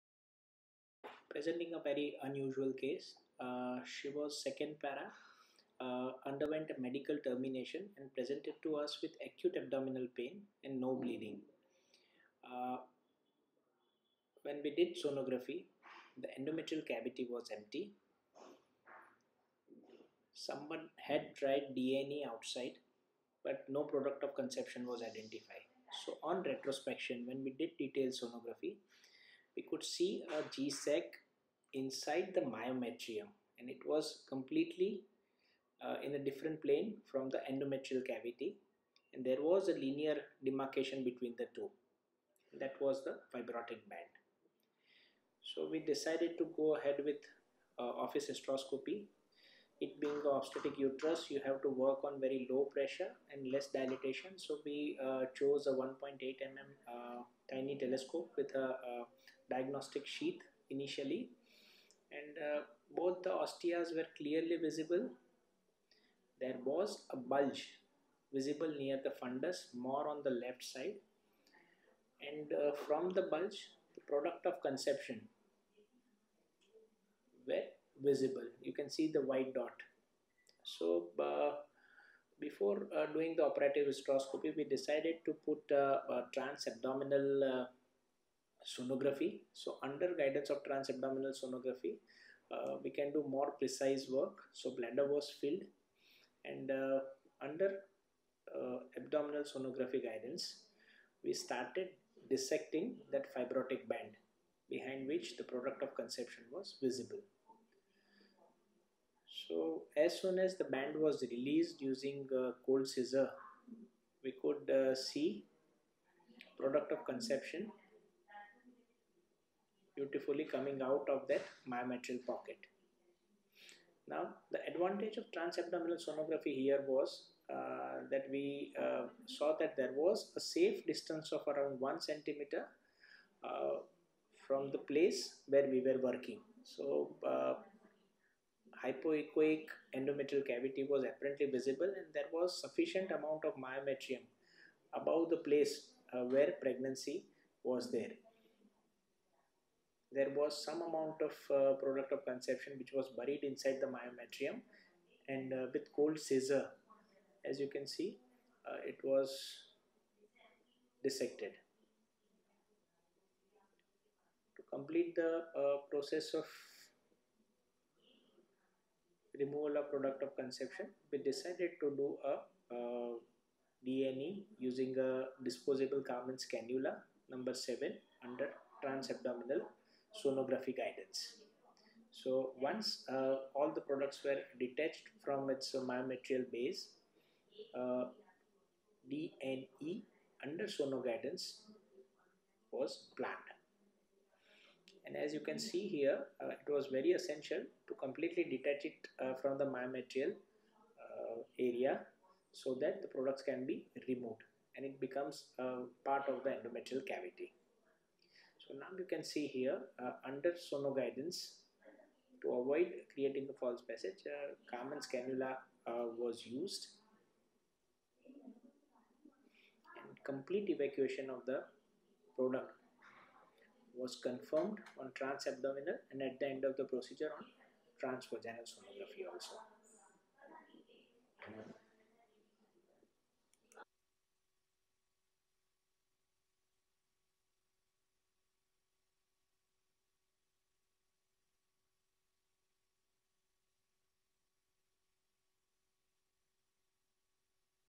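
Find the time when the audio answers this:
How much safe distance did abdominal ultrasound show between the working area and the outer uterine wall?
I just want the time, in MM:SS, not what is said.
02:11.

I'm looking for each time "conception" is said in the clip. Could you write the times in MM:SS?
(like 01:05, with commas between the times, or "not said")
00:24, 01:14, 01:45, 01:57, 02:32, 02:50.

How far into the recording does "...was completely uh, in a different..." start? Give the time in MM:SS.
00:33.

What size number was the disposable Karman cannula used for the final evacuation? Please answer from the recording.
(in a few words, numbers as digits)
7.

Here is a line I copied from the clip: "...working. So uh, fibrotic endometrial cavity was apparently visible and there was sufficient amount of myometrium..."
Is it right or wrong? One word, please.
wrong.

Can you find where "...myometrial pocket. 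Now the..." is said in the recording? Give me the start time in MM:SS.
02:01.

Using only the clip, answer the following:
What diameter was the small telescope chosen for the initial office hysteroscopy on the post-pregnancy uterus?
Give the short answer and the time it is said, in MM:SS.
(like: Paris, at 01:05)
1.8 mm, at 00:55.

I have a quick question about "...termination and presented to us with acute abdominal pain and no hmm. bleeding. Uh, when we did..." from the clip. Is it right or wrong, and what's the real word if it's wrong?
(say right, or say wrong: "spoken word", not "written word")
right.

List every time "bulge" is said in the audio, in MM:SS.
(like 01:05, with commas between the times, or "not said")
01:07, 01:13.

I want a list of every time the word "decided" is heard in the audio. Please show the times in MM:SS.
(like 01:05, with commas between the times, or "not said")
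00:45, 01:24, 02:51.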